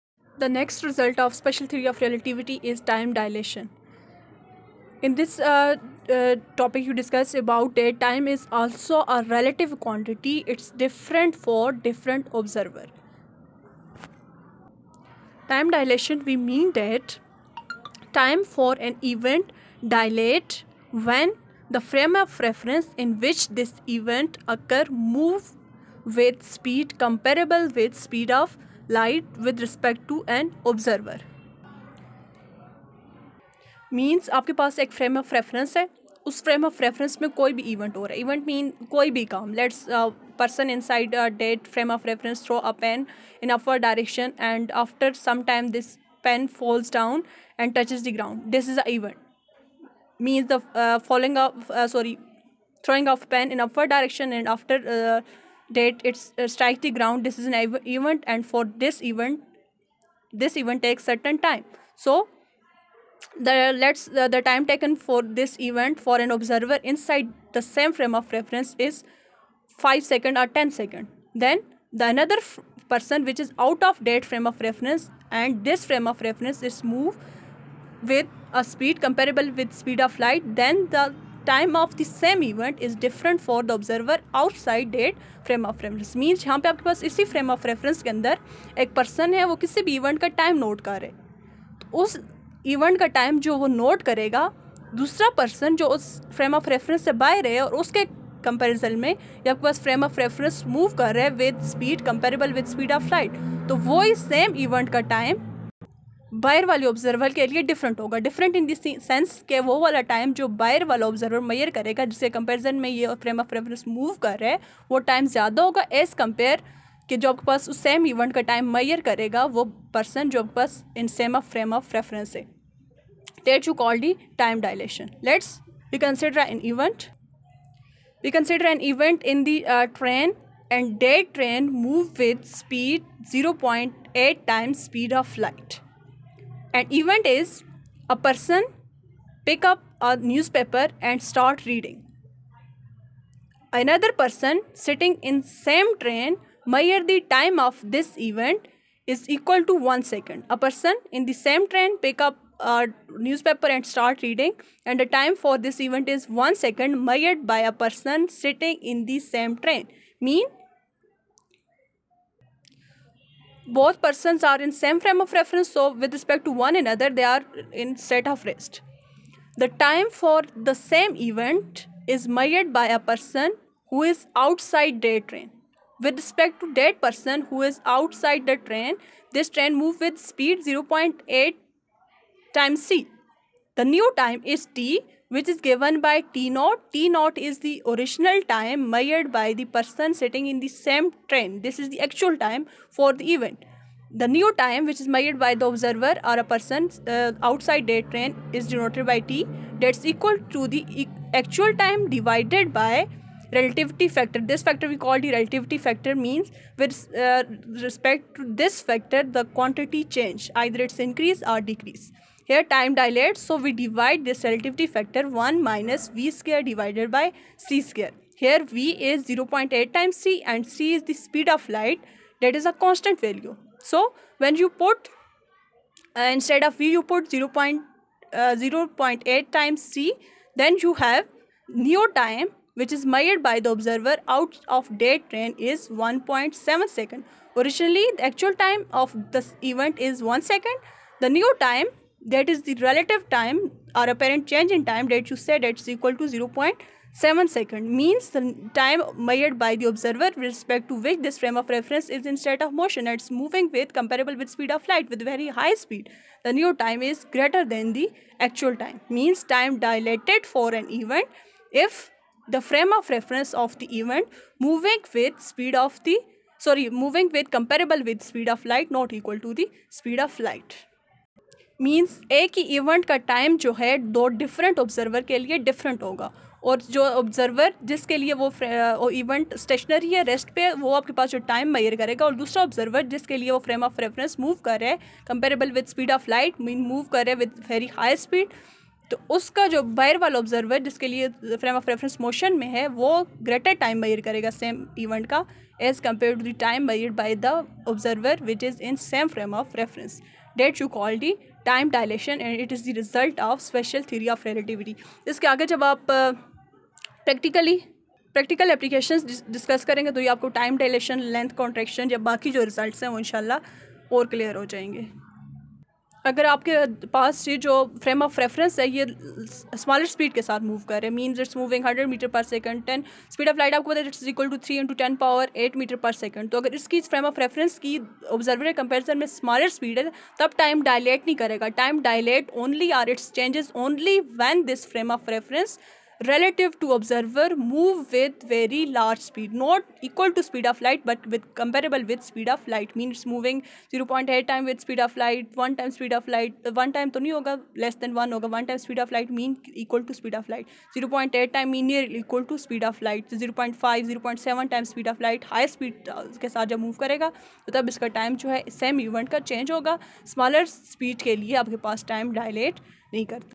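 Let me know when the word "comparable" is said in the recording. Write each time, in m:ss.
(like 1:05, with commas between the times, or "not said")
0:26, 1:19, 4:13, 4:27, 5:41.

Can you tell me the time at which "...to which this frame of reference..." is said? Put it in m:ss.
4:10.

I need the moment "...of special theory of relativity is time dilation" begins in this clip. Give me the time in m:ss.
0:01.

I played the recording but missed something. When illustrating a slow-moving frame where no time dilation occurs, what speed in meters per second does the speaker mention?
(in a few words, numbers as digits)
100 meters per second.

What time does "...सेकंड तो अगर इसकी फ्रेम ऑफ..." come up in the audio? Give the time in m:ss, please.
5:26.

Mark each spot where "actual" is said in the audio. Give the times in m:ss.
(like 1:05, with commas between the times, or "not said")
3:12, 3:21, 3:58, 4:18.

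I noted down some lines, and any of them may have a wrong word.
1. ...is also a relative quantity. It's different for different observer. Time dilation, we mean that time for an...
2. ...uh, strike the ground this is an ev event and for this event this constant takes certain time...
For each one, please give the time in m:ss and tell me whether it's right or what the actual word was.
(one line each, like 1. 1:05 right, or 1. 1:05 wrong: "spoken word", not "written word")
1. 0:08 right
2. 0:56 wrong: "event", not "constant".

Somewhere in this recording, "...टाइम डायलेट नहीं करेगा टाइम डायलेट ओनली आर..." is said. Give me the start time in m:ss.
5:30.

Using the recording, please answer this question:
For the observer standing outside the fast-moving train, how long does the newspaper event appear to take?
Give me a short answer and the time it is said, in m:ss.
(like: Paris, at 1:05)
1.7 seconds, at 3:55.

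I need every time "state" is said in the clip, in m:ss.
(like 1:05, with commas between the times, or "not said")
2:48, 4:12.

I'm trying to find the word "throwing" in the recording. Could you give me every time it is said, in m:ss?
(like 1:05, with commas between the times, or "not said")
0:52.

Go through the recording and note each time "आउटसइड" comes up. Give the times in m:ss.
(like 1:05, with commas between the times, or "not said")
1:24.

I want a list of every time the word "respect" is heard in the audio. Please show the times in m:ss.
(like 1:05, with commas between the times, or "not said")
0:29, 2:46, 2:56, 3:27, 4:10.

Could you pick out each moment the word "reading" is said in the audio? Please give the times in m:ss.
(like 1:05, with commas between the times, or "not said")
2:21, 2:34.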